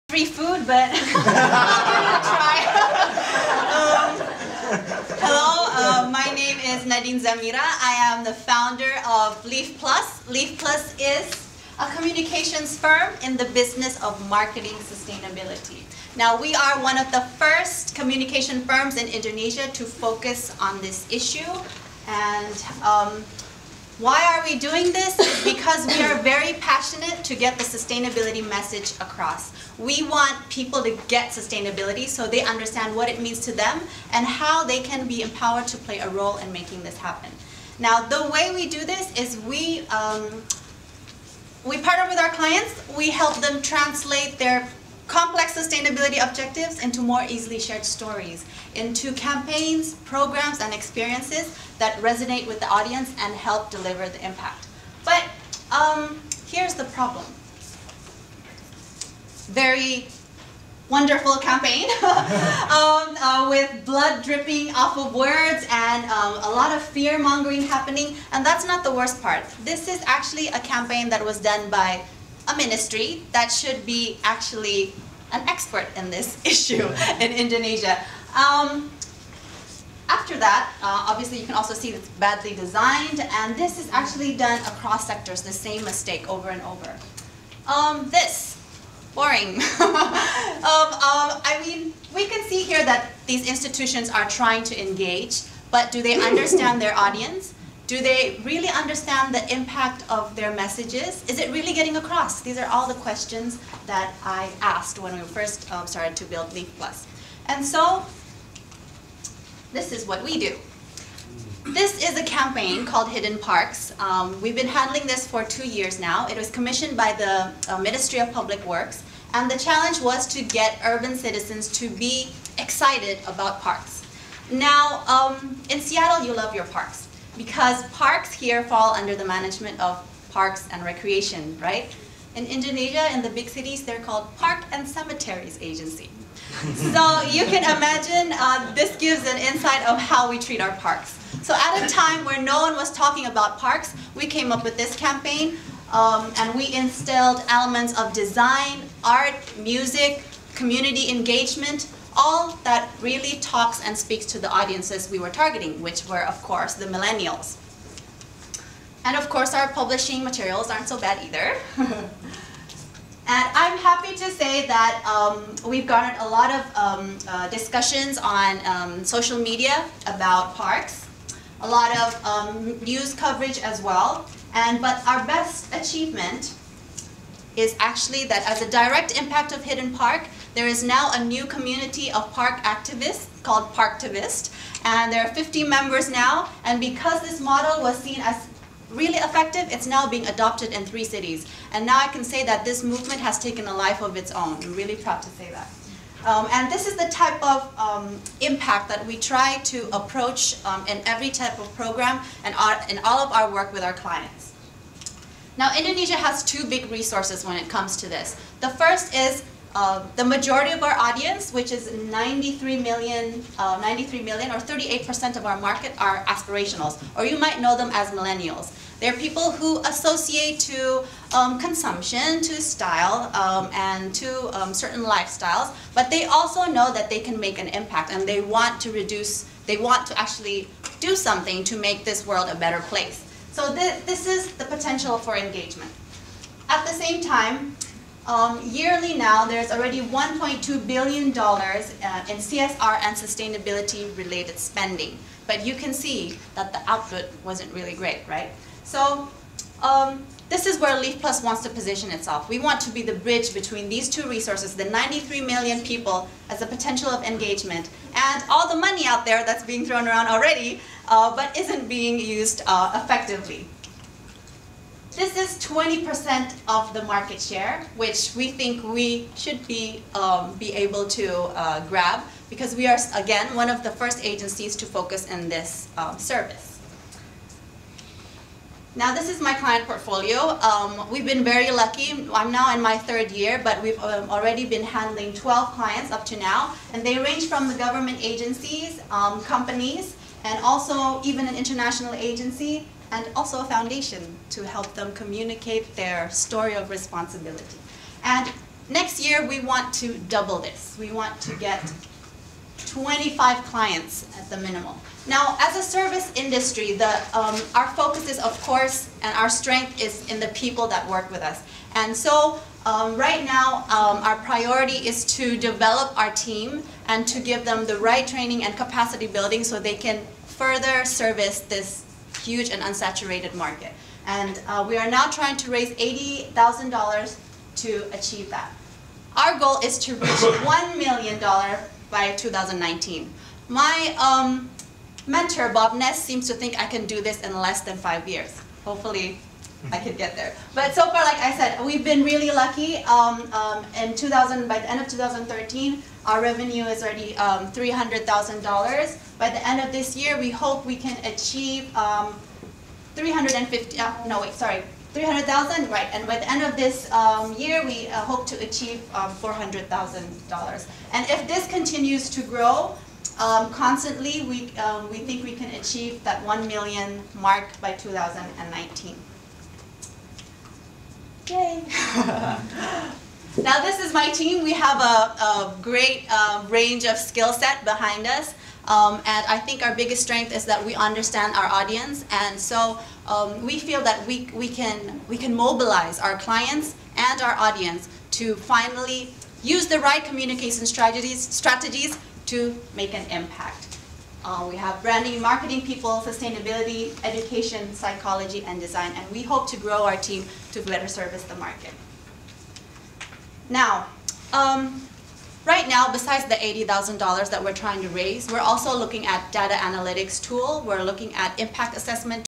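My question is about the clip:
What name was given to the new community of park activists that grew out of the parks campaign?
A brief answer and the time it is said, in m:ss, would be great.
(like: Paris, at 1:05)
Parktivist, at 3:03.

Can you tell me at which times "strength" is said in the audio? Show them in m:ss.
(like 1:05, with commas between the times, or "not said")
5:09, 6:20.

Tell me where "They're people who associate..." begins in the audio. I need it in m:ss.
3:39.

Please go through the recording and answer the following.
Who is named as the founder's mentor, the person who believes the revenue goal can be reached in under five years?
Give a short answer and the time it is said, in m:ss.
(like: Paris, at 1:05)
Bob Ness, at 5:35.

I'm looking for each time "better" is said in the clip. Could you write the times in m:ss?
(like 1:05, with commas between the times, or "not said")
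3:52, 6:40.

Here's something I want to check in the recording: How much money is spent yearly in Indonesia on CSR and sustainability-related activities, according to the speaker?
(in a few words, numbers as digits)
$1.2 billion.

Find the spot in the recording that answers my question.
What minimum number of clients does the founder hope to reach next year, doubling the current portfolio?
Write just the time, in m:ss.
5:02.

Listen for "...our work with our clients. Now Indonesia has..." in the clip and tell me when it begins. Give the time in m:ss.
3:23.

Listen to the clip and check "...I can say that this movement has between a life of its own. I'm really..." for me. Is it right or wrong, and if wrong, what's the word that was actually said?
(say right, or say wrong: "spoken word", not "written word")
wrong: "taken", not "between".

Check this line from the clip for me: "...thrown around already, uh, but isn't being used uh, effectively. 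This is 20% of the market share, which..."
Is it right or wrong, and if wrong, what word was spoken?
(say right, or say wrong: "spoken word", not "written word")
right.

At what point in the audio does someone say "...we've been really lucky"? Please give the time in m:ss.
5:41.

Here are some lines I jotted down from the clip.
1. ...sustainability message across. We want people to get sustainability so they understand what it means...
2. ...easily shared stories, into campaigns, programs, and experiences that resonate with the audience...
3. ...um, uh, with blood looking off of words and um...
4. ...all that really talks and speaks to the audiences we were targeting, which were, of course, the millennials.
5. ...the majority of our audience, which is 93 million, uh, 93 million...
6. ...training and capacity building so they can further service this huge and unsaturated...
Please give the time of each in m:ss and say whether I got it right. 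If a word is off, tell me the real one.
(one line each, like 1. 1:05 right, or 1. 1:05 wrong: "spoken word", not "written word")
1. 0:27 right
2. 0:47 right
3. 1:02 wrong: "dripping", not "looking"
4. 2:32 right
5. 3:30 right
6. 5:18 right.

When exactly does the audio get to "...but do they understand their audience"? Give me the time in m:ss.
1:35.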